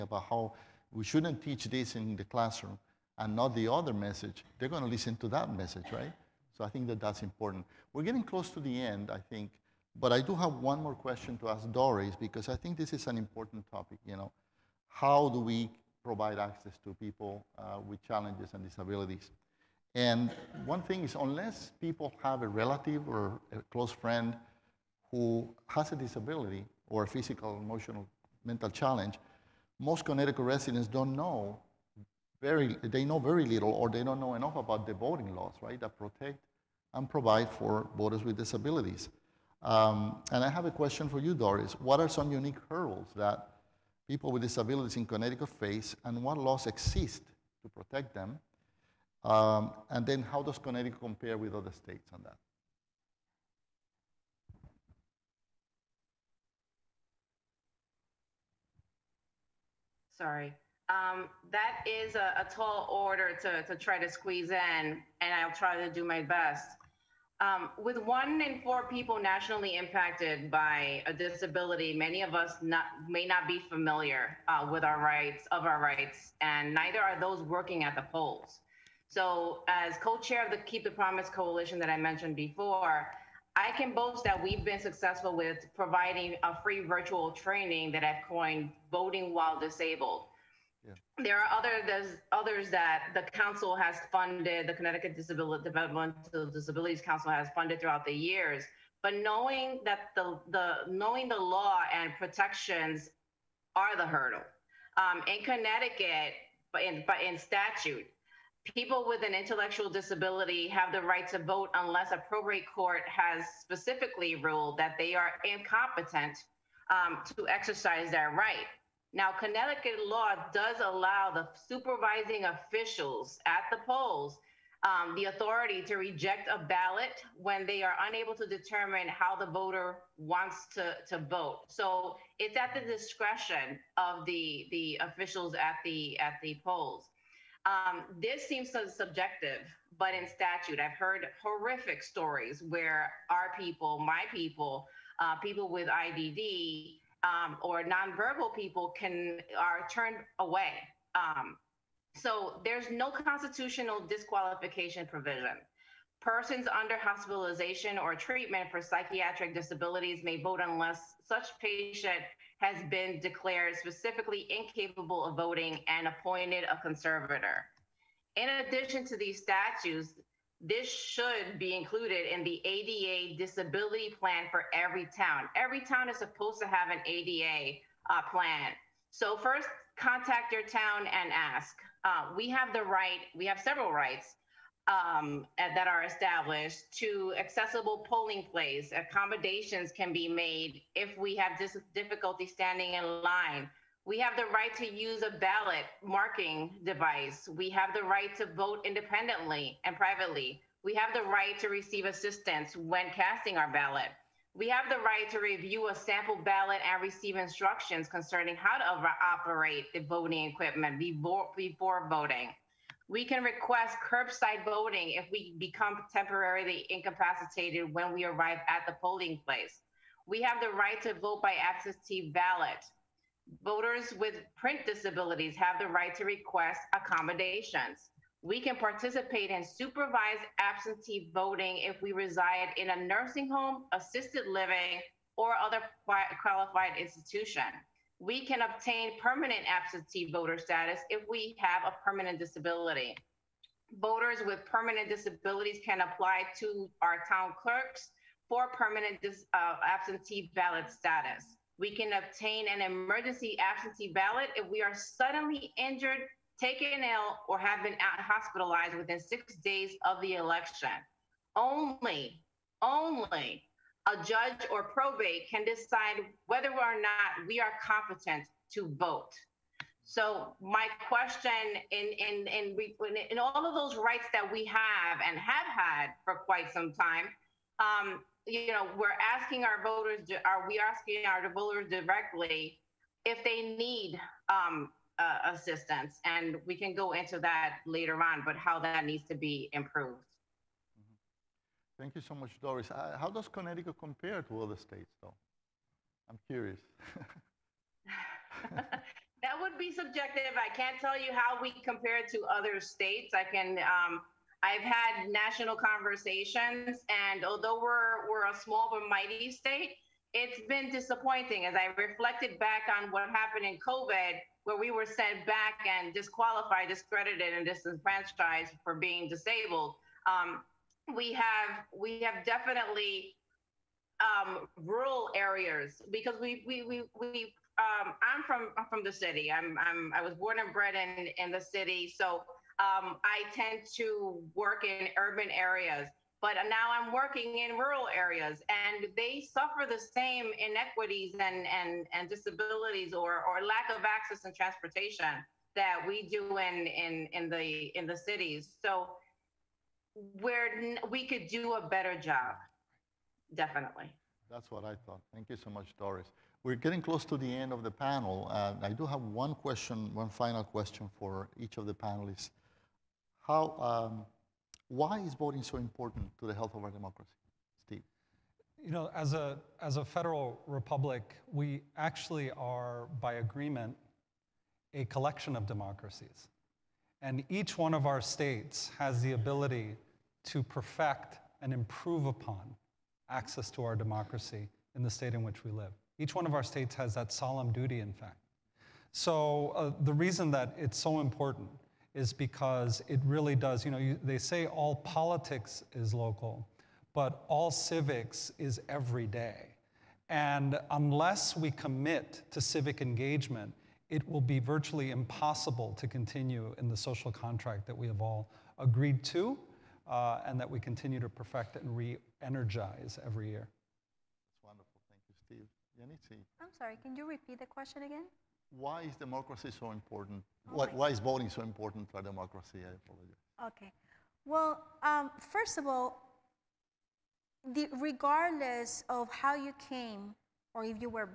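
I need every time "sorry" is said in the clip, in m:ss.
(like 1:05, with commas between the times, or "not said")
1:00, 6:56.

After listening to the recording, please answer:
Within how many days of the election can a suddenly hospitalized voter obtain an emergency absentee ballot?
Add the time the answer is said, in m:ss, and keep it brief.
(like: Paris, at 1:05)
6, at 4:19.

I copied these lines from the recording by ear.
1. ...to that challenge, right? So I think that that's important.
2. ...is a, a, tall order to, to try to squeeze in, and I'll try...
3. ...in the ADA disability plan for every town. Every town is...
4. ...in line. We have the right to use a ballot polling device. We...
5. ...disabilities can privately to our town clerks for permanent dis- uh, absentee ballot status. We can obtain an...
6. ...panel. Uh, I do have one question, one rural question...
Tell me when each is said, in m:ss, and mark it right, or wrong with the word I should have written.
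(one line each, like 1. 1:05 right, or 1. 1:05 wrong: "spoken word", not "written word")
1. 0:05 wrong: "message", not "challenge"
2. 1:01 right
3. 2:52 right
4. 3:12 wrong: "marking", not "polling"
5. 4:05 wrong: "apply", not "privately"
6. 5:57 wrong: "final", not "rural".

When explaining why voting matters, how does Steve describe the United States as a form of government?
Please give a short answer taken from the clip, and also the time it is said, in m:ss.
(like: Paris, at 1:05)
Federal republic, at 6:10.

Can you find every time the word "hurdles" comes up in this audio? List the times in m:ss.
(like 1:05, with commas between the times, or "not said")
0:42, 1:44.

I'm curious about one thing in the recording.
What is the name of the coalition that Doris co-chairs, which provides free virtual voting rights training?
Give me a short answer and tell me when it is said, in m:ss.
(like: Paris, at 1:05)
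Keep the Promise Coalition, at 1:20.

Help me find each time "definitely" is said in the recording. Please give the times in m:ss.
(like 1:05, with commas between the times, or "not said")
5:22, 5:53.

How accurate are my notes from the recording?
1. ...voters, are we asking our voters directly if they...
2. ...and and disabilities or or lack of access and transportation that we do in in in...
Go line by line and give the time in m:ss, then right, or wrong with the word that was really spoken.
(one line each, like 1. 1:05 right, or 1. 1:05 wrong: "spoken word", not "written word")
1. 4:39 right
2. 5:41 right.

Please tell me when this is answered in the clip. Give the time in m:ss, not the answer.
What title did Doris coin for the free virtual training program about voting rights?
1:28.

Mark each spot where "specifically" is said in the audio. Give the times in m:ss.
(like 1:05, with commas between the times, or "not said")
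1:53, 2:43.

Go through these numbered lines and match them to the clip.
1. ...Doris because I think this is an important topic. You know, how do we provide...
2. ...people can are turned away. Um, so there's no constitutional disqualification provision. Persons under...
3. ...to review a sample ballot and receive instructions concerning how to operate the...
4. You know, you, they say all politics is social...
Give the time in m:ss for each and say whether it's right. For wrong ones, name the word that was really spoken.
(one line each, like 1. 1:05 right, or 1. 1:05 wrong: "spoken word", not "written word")
1. 0:11 right
2. 2:28 right
3. 3:25 right
4. 6:33 wrong: "local", not "social".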